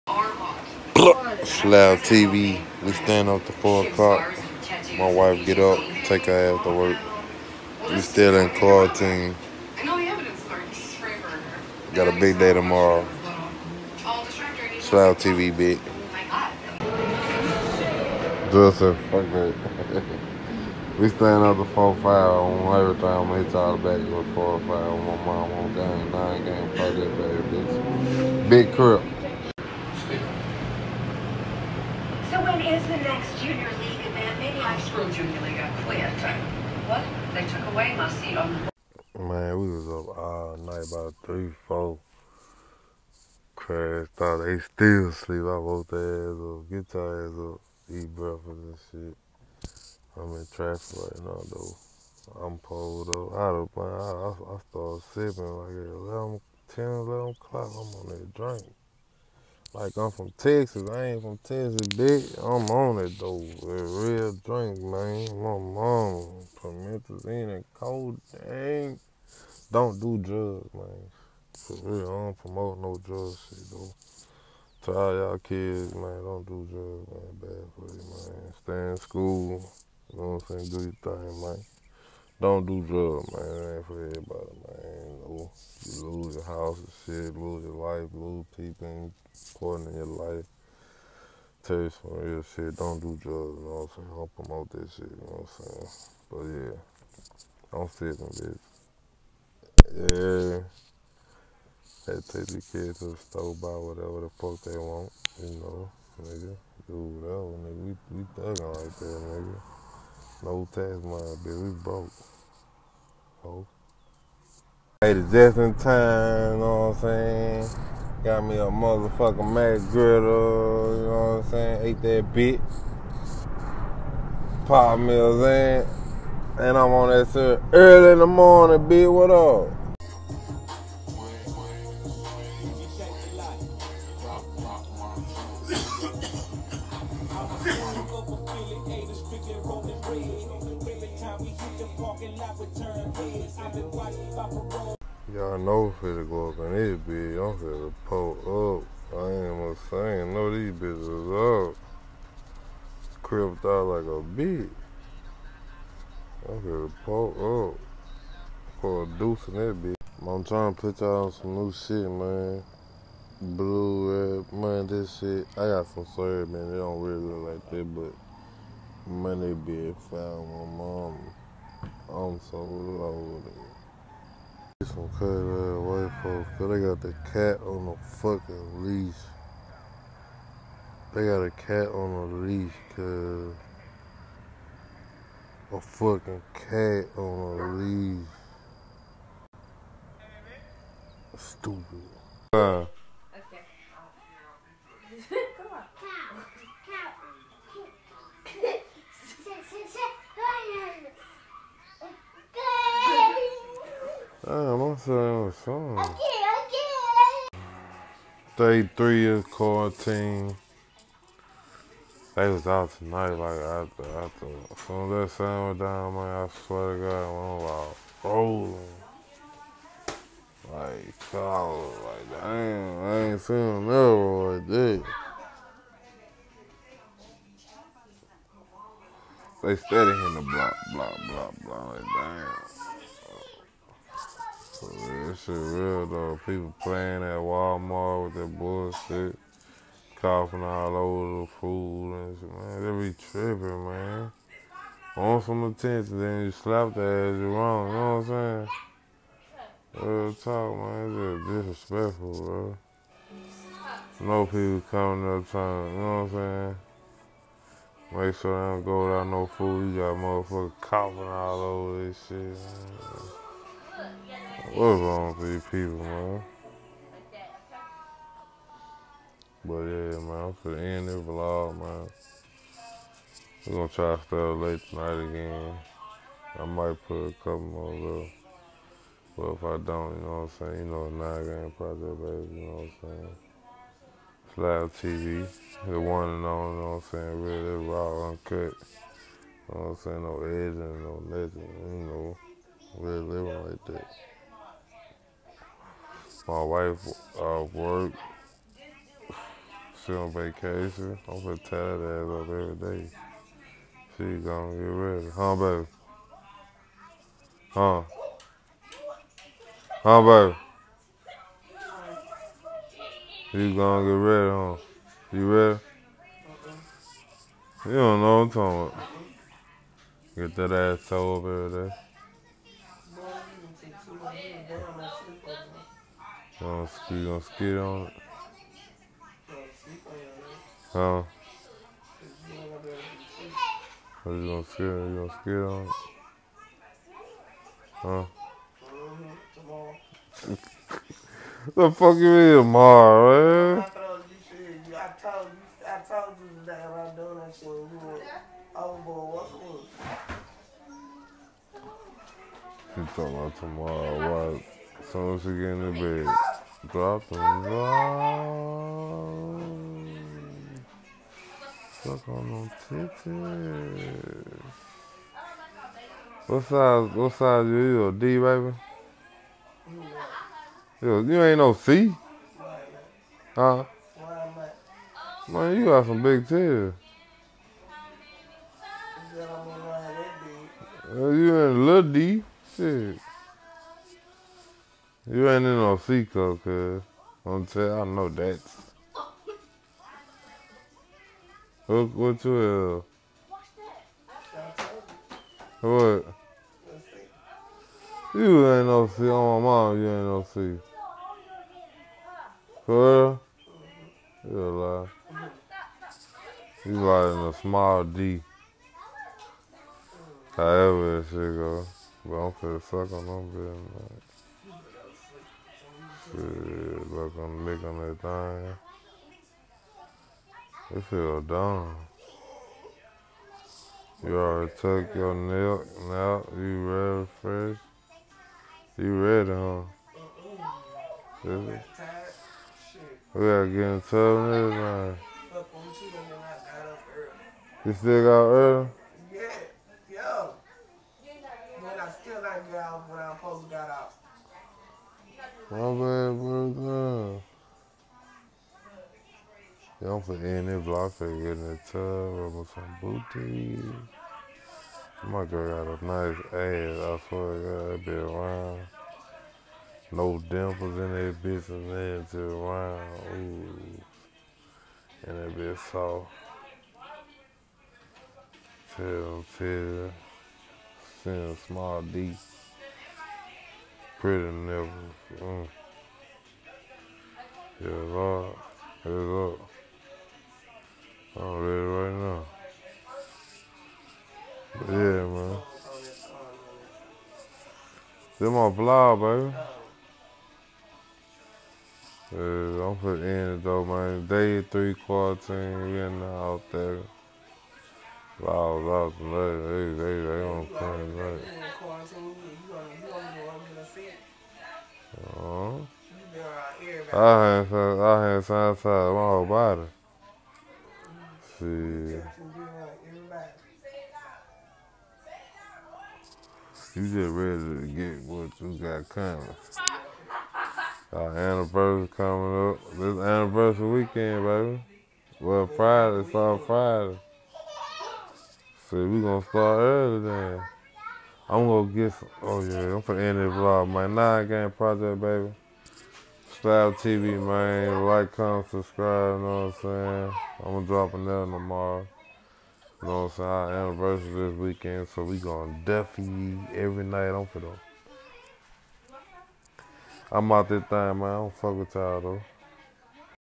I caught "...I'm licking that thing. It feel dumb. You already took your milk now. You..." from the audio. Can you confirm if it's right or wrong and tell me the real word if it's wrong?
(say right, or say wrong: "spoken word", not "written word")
right.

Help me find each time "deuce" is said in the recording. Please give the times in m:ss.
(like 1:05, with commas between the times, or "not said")
2:39.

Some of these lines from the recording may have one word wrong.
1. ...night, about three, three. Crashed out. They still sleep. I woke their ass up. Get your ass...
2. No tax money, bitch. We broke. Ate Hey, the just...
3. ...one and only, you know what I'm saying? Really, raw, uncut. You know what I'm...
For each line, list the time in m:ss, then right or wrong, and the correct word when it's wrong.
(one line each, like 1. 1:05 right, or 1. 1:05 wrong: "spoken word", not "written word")
1. 0:40 wrong: "four", not "three"
2. 1:50 right
3. 4:45 right.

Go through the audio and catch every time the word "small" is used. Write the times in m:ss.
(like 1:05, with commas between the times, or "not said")
6:47, 7:51.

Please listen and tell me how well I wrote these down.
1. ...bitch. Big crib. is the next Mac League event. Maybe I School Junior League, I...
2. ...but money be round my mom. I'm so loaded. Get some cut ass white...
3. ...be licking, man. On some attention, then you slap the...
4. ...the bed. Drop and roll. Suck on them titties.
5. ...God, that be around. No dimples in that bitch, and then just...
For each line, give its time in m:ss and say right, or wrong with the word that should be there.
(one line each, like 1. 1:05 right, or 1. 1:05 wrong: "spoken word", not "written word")
1. 0:27 wrong: "Junior", not "Mac"
2. 2:47 wrong: "found", not "round"
3. 4:03 wrong: "tripping", not "licking"
4. 5:55 right
5. 7:37 right.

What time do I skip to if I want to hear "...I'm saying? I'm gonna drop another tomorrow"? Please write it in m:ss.
8:59.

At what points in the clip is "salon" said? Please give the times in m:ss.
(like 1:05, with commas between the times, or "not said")
not said.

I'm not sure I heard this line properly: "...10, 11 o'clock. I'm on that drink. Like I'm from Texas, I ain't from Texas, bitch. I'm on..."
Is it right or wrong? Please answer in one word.
right.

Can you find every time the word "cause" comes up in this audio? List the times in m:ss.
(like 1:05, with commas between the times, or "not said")
2:56, 3:02.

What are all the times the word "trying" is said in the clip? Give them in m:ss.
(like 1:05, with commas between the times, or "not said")
2:40, 4:15.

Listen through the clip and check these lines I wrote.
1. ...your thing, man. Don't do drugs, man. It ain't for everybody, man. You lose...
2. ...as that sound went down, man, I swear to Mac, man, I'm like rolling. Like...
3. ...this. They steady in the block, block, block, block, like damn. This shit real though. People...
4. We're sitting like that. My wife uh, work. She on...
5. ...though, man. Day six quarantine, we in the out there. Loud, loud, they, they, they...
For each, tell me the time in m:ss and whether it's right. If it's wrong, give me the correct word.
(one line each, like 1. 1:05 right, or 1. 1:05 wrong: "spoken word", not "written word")
1. 1:21 right
2. 3:35 wrong: "God", not "Mac"
3. 3:44 right
4. 4:52 wrong: "living", not "sitting"
5. 8:13 wrong: "three", not "six".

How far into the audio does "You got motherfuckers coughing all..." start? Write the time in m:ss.
4:19.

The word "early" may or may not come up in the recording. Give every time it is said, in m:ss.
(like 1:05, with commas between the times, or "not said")
2:07, 7:18, 8:49.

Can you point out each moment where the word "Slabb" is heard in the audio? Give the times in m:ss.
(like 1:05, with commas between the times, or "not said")
0:01, 0:14, 4:44.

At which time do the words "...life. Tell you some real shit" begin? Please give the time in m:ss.
1:30.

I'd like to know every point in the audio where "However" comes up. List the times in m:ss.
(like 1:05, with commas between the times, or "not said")
6:50.